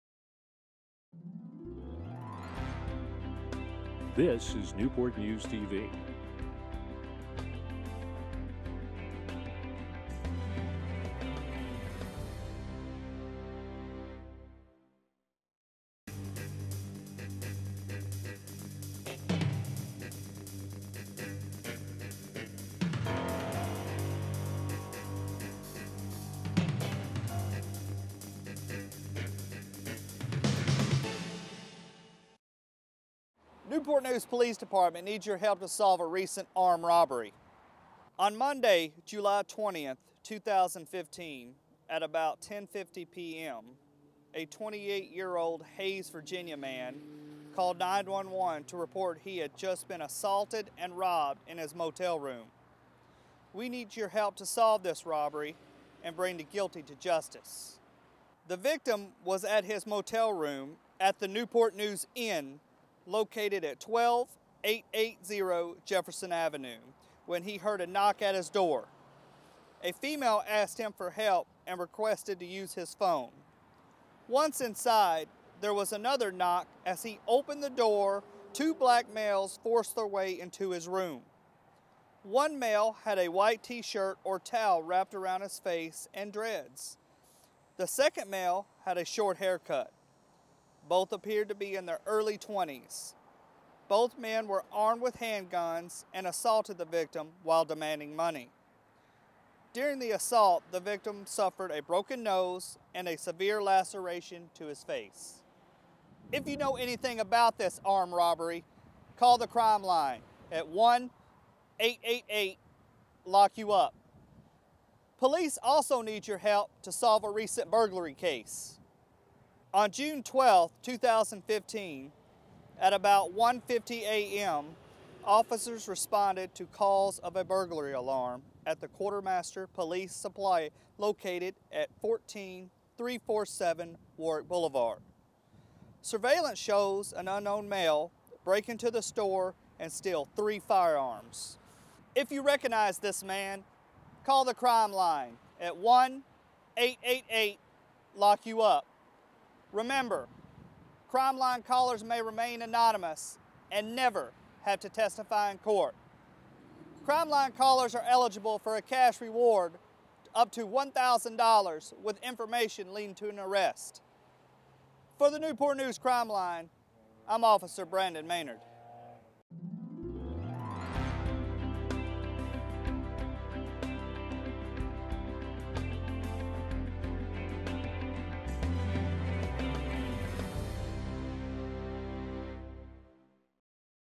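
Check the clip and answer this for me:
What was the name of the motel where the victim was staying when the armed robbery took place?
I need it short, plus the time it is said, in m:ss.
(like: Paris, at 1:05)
Newport News Inn, at 1:01.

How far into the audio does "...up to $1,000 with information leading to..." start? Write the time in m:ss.
2:40.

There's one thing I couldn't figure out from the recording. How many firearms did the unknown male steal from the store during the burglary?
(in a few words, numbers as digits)
3.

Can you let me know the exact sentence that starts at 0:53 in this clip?
We need your help to solve this robbery and bring the guilty to justice.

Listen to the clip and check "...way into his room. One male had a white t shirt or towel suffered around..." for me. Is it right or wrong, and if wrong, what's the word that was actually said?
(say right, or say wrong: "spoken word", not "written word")
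wrong: "wrapped", not "suffered".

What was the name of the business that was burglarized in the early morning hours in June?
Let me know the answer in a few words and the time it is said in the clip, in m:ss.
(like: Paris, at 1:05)
Quartermaster Police Supply, at 2:08.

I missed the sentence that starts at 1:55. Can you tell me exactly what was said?
Police also need your help to solve a recent burglary case.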